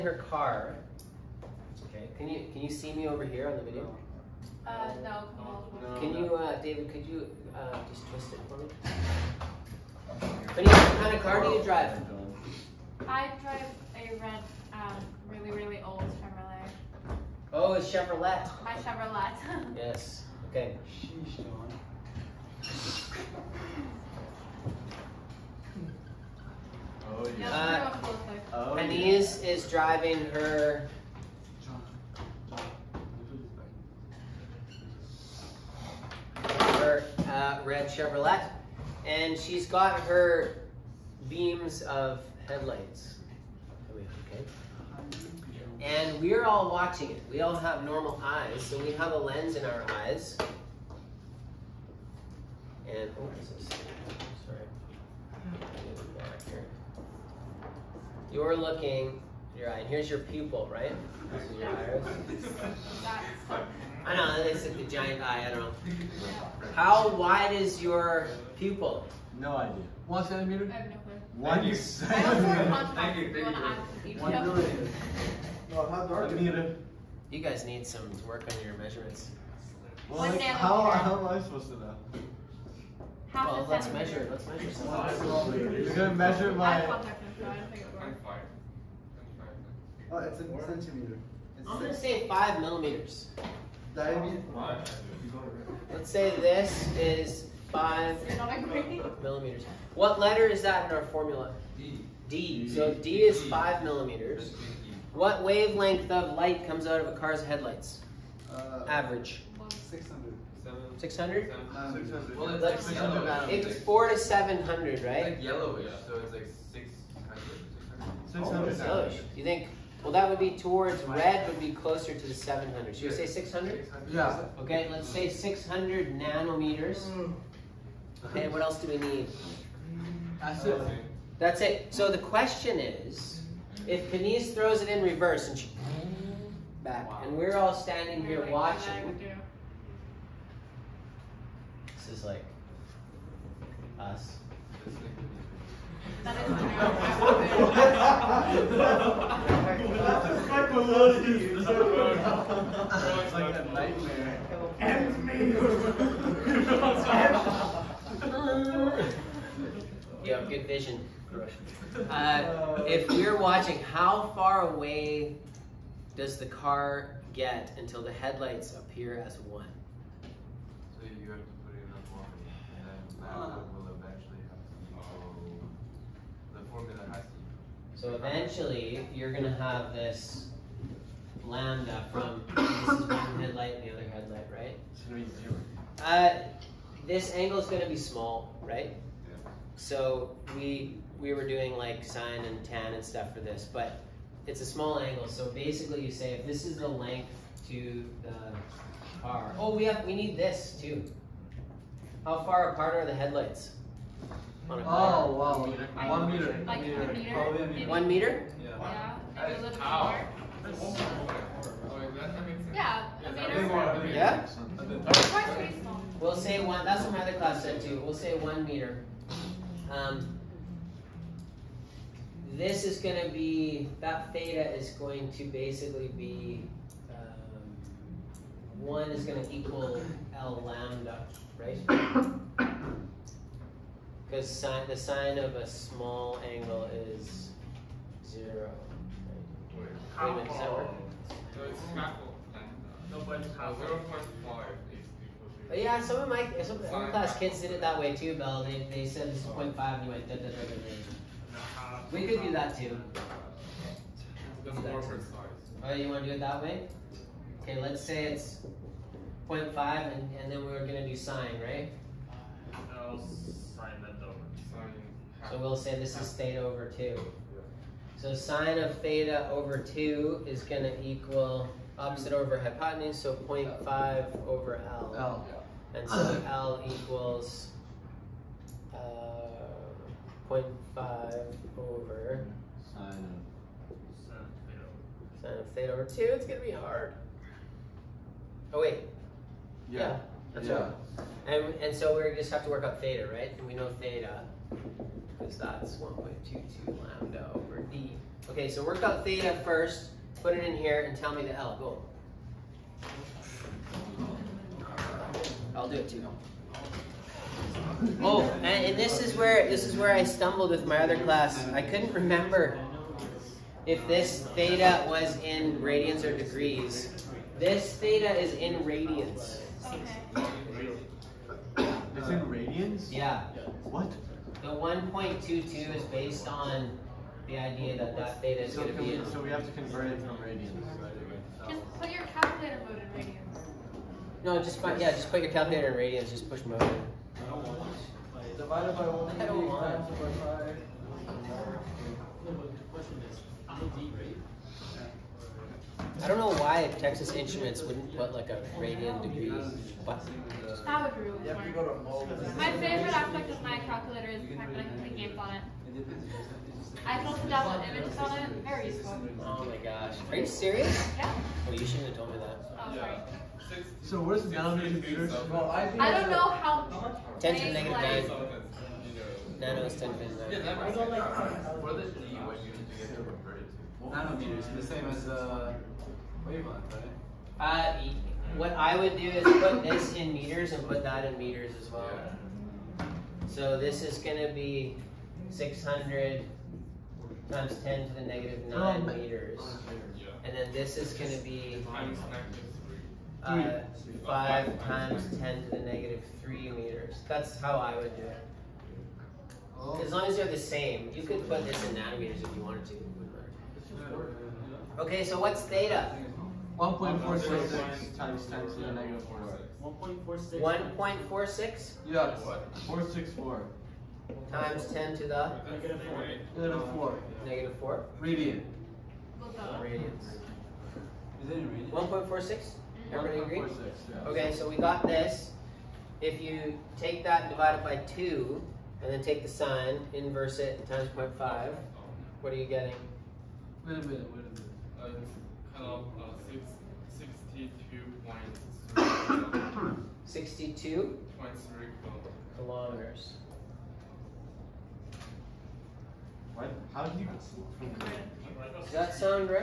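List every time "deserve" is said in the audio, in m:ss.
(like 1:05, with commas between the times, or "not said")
not said.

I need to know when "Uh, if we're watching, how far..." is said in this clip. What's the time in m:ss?
2:42.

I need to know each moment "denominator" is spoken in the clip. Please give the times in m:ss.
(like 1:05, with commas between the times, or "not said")
6:04.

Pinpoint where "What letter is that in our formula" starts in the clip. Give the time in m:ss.
1:39.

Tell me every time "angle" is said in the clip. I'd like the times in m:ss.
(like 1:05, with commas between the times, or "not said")
3:07, 3:14, 3:56.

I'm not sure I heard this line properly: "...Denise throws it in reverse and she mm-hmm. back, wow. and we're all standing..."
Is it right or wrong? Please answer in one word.
right.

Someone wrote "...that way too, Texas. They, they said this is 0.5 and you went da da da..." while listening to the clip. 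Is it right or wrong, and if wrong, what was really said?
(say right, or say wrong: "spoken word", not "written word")
wrong: "Bell", not "Texas".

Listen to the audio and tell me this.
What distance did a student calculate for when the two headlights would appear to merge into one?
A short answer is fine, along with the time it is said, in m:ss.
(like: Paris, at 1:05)
62.3 kilometers, at 7:18.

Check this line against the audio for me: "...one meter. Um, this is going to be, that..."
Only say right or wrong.
right.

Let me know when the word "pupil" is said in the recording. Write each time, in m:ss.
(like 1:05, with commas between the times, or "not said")
1:00, 1:08.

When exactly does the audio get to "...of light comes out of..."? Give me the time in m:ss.
1:46.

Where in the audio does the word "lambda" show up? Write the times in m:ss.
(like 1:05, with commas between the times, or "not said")
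3:01, 3:50, 4:00, 4:56.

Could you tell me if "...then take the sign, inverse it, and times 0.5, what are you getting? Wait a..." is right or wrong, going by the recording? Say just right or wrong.
right.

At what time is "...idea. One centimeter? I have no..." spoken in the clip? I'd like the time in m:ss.
1:09.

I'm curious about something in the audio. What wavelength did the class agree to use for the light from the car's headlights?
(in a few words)
600 nanometers.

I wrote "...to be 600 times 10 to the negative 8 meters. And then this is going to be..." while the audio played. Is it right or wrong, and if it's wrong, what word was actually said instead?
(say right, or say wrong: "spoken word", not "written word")
wrong: "9", not "8".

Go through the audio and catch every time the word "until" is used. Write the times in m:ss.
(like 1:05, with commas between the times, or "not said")
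2:47.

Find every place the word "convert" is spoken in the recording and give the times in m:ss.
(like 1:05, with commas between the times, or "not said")
5:29.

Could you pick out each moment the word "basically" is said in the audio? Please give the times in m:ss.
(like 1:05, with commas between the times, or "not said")
3:15, 3:45.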